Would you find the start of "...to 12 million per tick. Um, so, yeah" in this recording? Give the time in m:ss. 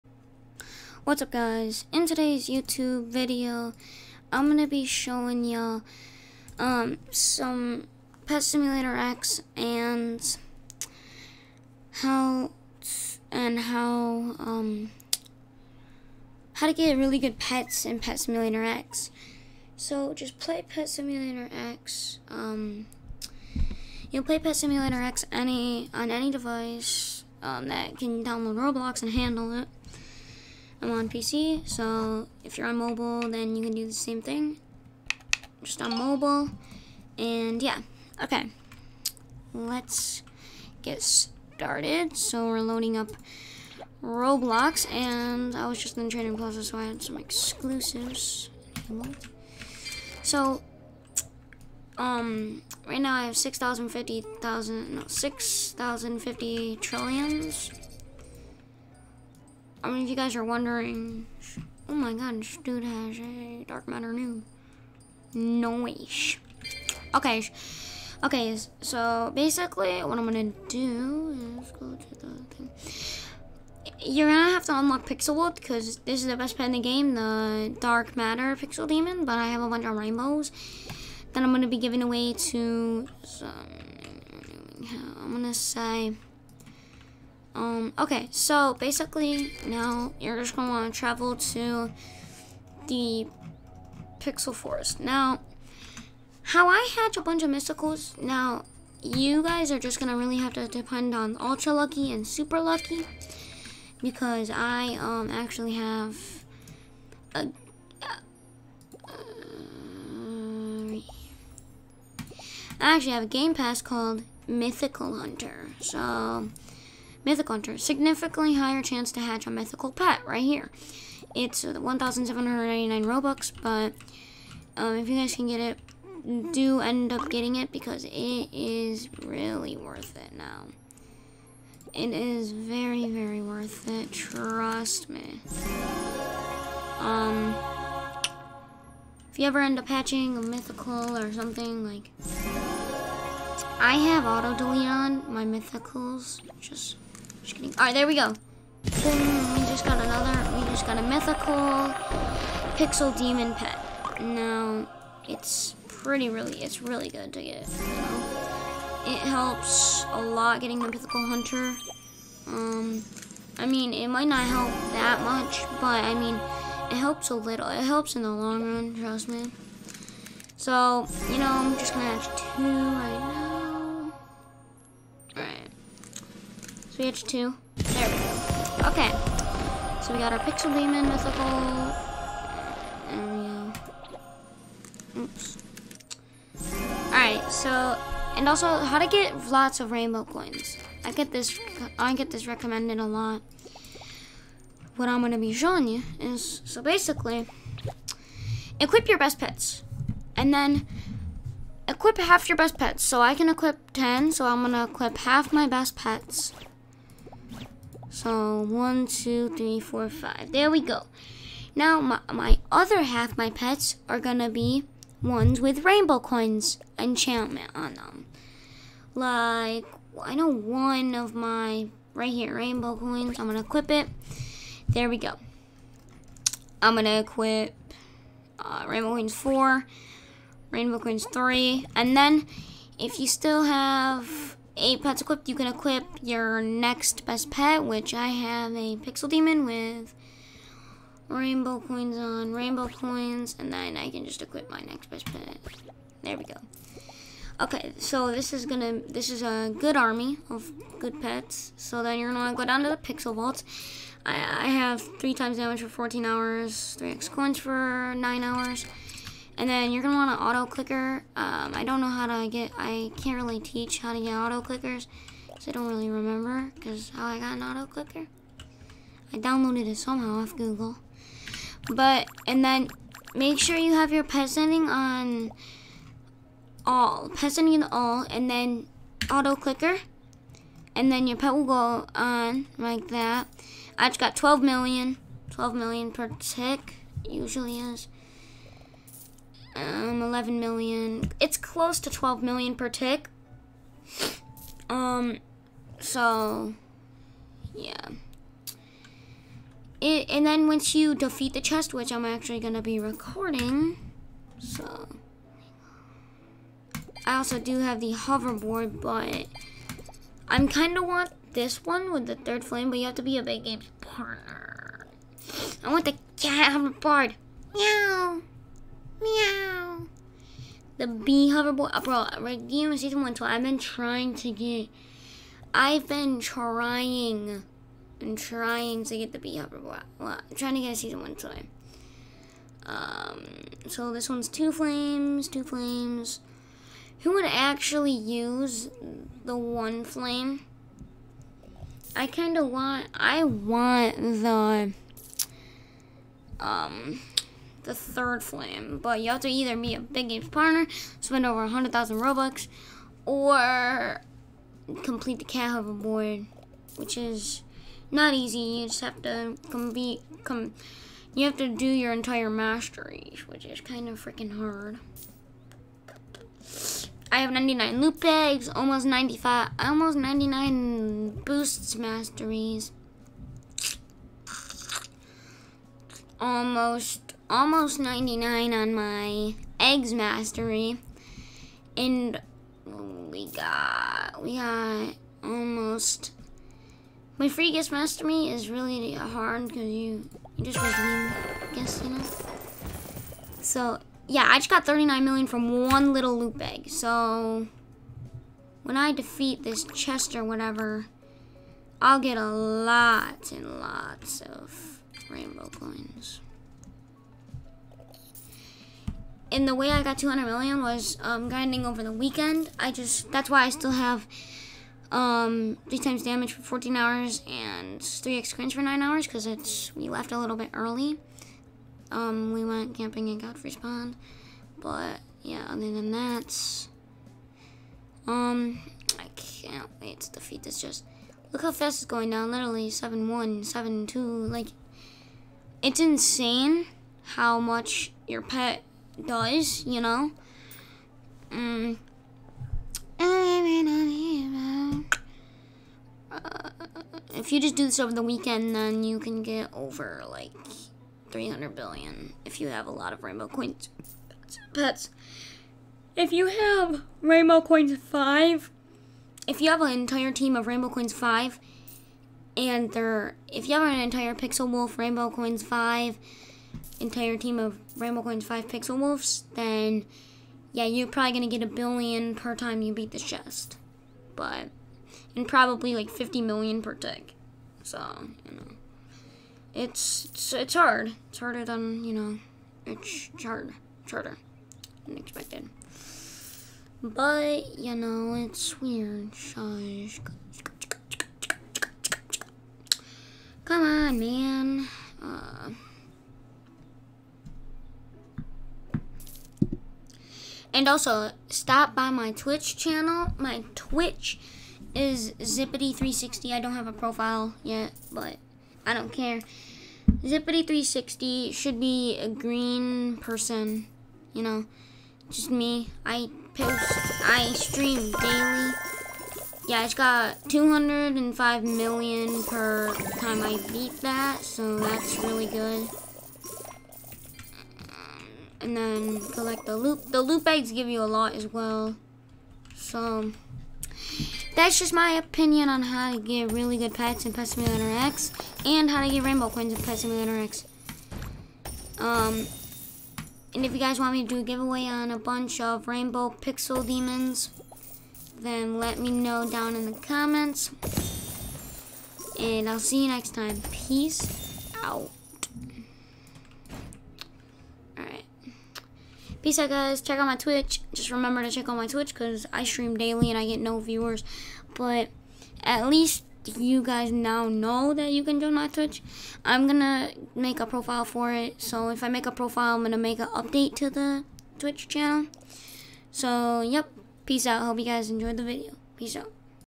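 4:52.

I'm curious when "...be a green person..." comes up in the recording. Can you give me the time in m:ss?
8:31.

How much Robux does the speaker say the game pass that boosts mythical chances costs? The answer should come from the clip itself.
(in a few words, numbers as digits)
1,799.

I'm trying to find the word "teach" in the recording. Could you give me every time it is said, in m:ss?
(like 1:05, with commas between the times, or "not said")
4:23.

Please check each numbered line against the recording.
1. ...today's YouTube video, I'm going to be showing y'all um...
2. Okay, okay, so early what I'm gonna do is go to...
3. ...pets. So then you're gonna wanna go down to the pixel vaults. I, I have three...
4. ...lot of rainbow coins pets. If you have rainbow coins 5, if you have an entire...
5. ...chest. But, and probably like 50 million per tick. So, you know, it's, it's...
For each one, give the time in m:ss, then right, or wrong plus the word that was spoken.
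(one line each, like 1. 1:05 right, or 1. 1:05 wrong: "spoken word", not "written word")
1. 0:02 right
2. 1:07 wrong: "basically", not "early"
3. 4:11 right
4. 7:32 right
5. 7:53 right.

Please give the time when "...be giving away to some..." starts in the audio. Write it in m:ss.
1:21.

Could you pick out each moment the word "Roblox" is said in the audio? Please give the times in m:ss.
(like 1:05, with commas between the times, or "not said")
0:28, 0:44.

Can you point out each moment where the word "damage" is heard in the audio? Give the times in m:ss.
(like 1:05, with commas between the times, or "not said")
4:15, 6:56.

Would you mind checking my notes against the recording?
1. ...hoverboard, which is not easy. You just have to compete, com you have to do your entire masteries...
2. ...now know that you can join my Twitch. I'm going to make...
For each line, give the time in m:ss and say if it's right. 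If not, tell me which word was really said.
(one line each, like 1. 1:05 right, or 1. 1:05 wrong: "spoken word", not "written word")
1. 5:55 right
2. 9:27 right.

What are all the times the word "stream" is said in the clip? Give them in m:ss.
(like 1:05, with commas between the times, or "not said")
8:37, 9:22.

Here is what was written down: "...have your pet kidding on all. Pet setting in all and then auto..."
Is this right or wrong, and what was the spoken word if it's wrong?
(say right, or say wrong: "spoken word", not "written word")
wrong: "setting", not "kidding".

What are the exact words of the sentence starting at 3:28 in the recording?
So one, two, three, four, five.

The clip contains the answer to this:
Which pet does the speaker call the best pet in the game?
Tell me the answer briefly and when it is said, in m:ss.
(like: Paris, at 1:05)
Dark Matter Pixel Demon, at 1:17.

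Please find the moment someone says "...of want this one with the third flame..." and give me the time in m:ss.
5:10.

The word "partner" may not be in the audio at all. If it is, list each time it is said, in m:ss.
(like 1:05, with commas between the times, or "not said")
5:14, 5:50.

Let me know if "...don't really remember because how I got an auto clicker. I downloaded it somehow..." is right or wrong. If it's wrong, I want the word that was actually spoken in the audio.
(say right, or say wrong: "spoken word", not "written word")
right.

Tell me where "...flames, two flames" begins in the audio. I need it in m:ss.
5:34.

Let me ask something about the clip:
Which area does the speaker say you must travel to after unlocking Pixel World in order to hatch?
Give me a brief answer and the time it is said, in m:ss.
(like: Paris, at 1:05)
Pixel Forest, at 1:34.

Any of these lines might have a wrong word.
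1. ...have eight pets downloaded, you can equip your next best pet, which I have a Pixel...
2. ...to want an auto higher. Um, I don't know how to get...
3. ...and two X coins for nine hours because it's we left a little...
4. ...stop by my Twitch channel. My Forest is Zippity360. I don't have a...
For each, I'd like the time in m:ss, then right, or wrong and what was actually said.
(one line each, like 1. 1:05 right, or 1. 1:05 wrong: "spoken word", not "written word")
1. 3:53 wrong: "equipped", not "downloaded"
2. 4:20 wrong: "clicker", not "higher"
3. 6:57 wrong: "three", not "two"
4. 8:21 wrong: "Twitch", not "Forest".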